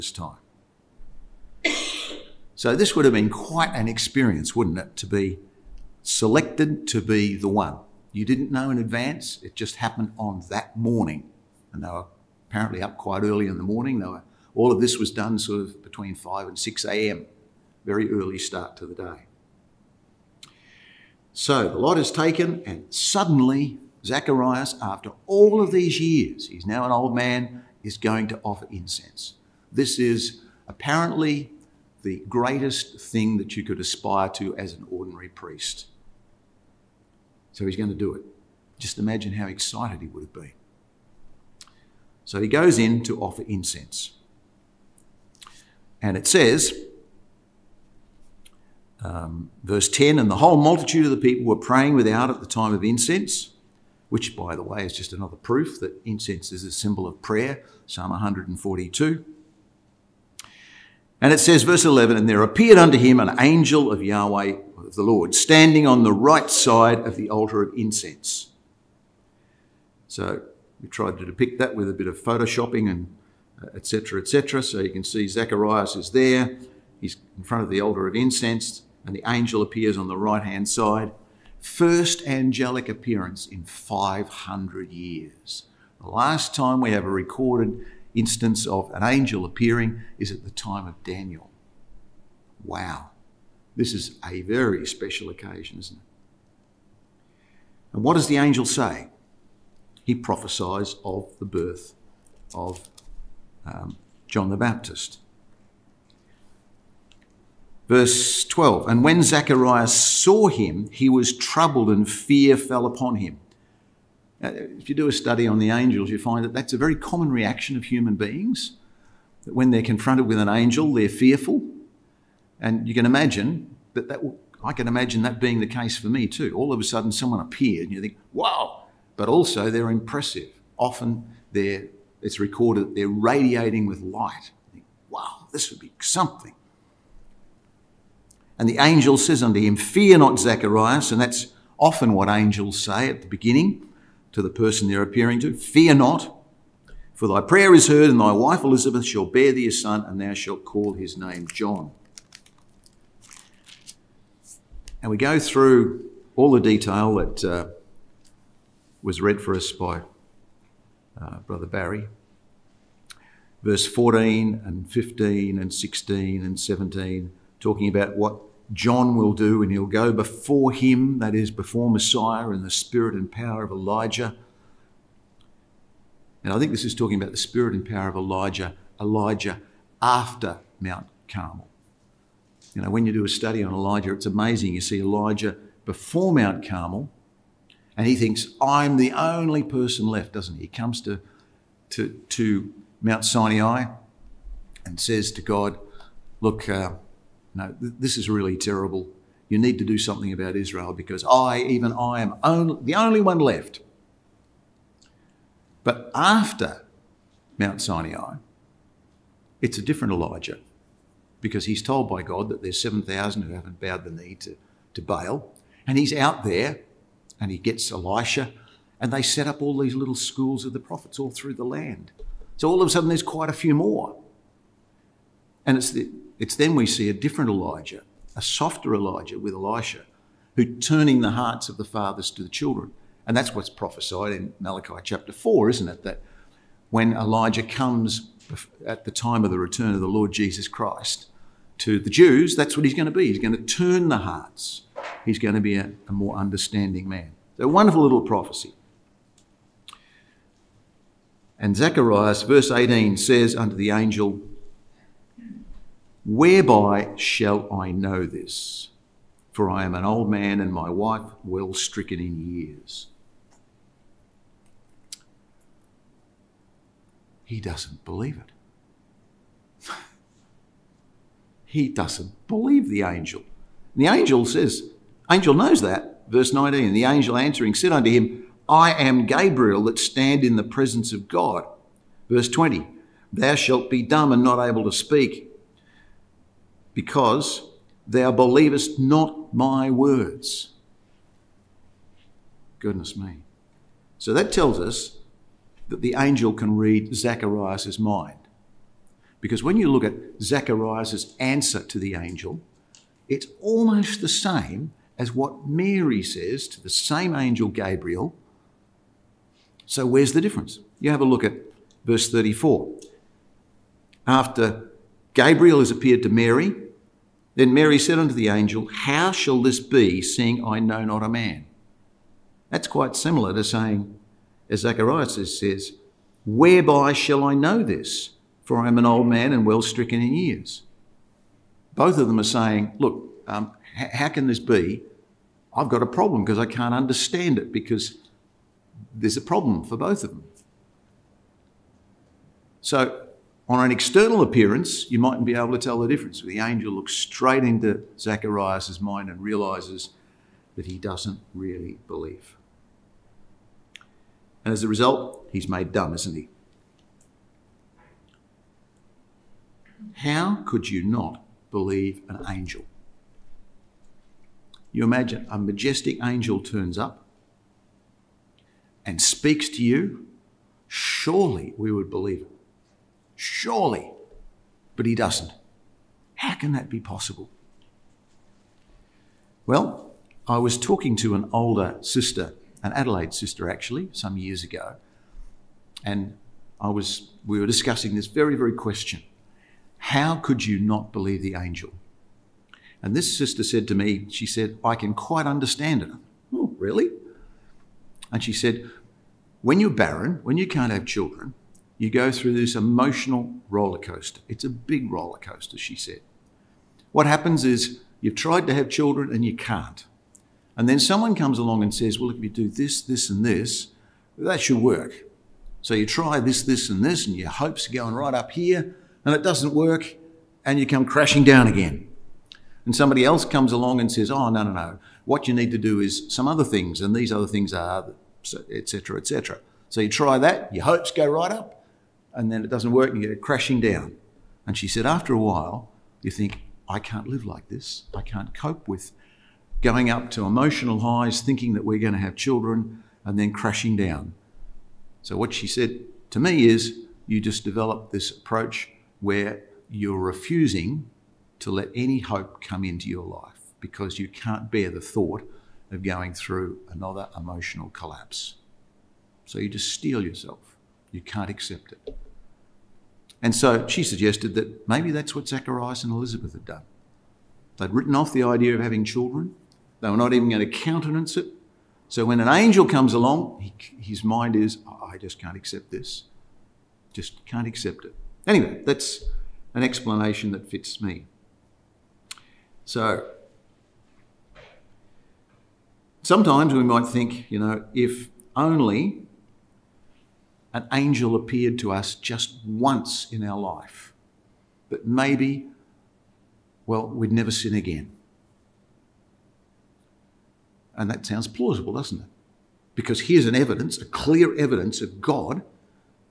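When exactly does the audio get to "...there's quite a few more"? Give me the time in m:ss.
3:43.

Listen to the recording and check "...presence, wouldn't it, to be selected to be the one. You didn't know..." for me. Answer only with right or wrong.
wrong.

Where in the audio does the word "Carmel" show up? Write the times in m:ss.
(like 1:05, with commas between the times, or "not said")
3:01, 3:06.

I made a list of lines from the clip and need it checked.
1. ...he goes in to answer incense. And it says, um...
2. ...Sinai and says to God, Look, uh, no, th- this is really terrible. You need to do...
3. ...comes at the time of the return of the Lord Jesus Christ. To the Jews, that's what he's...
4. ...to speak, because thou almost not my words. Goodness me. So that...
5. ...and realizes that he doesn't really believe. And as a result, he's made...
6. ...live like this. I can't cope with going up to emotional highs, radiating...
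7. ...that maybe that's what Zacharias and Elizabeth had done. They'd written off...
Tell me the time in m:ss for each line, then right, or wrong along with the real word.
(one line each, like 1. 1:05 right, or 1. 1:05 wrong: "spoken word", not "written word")
1. 0:42 wrong: "offer", not "answer"
2. 3:13 right
3. 3:57 right
4. 4:44 wrong: "believest", not "almost"
5. 5:49 right
6. 7:17 wrong: "thinking", not "radiating"
7. 7:44 right.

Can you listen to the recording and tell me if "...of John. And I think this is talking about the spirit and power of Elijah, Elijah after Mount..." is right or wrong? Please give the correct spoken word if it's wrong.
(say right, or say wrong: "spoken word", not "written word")
wrong: "Elijah", not "John".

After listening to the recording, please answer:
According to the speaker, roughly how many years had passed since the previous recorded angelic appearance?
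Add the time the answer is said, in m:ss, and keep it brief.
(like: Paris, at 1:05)
500 years, at 1:23.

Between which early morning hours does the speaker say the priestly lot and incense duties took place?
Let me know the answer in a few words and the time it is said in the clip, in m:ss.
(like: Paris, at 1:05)
5 and 6 a.m., at 0:15.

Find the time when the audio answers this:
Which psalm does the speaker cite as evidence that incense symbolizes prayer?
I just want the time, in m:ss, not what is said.
0:57.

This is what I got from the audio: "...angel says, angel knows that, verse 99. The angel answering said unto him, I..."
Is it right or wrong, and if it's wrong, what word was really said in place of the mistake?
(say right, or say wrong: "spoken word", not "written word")
wrong: "19", not "99".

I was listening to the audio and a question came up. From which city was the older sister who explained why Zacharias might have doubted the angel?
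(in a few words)
Adelaide.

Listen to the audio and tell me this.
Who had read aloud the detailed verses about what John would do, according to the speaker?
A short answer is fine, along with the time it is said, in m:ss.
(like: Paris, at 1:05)
Brother Barry, at 2:41.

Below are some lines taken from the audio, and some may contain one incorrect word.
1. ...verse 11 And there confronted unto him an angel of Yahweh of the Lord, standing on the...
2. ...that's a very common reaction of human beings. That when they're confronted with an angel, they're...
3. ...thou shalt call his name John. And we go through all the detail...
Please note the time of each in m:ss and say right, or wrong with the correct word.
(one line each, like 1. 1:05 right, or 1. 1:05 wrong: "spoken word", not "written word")
1. 1:01 wrong: "appeared", not "confronted"
2. 1:56 right
3. 2:30 right.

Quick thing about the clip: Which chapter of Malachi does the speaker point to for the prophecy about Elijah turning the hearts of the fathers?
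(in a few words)
Malachi chapter 4.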